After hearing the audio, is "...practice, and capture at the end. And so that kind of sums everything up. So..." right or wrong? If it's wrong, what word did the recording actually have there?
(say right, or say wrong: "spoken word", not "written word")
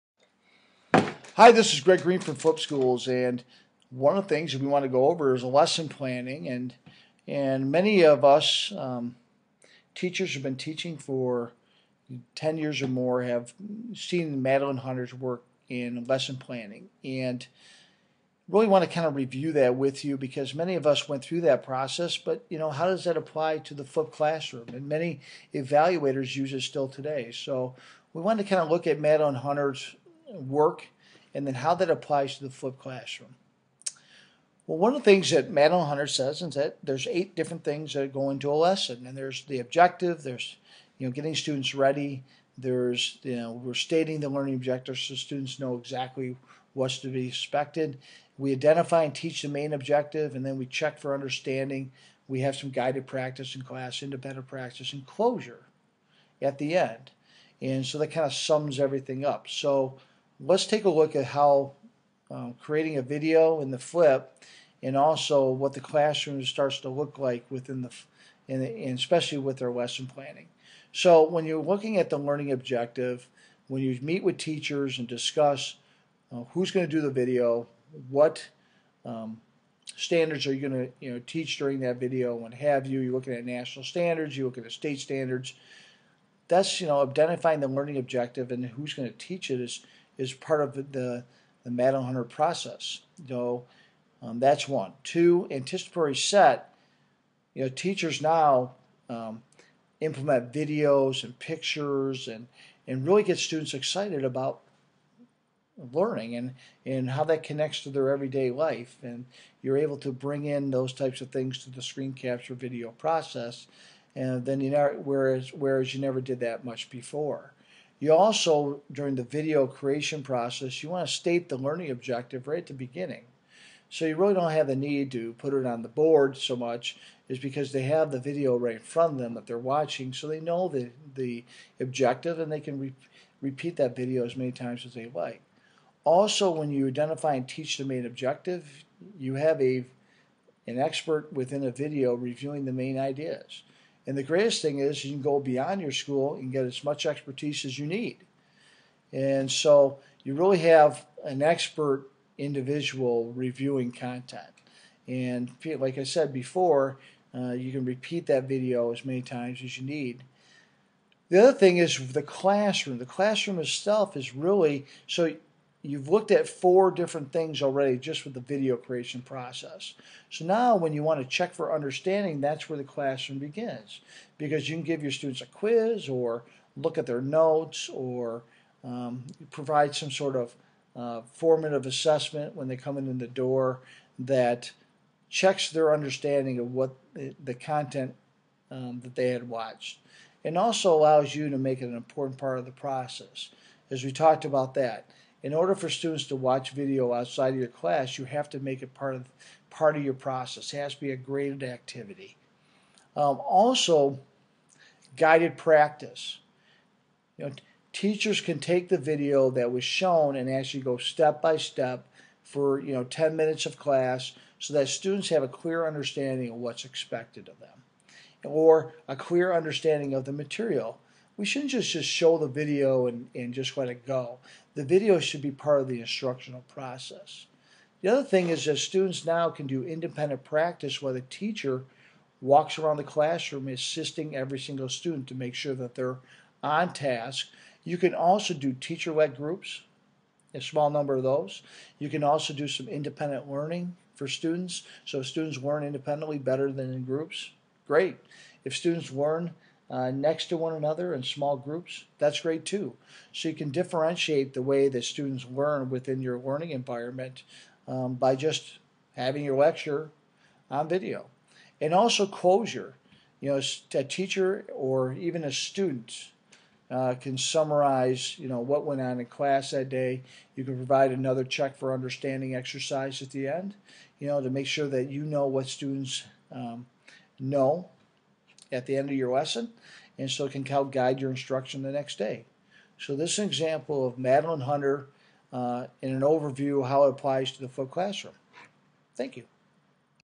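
wrong: "closure", not "capture".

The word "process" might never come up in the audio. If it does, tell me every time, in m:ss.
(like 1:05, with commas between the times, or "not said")
0:21, 1:32, 1:52, 2:00, 2:49, 3:12, 3:20, 3:46.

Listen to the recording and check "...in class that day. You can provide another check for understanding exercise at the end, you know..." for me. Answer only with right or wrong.
right.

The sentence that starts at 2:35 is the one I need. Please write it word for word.
And like I said before, uh, you can repeat that video as many times as you need.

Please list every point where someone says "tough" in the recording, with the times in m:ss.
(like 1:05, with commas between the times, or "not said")
not said.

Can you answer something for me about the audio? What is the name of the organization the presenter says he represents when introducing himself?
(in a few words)
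Flip Schools.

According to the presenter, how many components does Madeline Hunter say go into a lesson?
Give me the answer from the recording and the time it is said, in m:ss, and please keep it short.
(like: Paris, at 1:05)
8, at 0:37.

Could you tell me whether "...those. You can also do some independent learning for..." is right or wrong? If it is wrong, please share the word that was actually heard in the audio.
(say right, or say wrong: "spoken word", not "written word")
right.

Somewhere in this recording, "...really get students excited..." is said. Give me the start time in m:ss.
1:43.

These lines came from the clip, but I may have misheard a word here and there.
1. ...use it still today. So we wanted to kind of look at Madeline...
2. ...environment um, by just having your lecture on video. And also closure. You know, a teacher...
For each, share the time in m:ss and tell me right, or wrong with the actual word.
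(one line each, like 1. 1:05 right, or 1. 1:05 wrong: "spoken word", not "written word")
1. 0:26 right
2. 4:16 right.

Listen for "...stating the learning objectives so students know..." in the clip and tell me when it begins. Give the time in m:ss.
0:43.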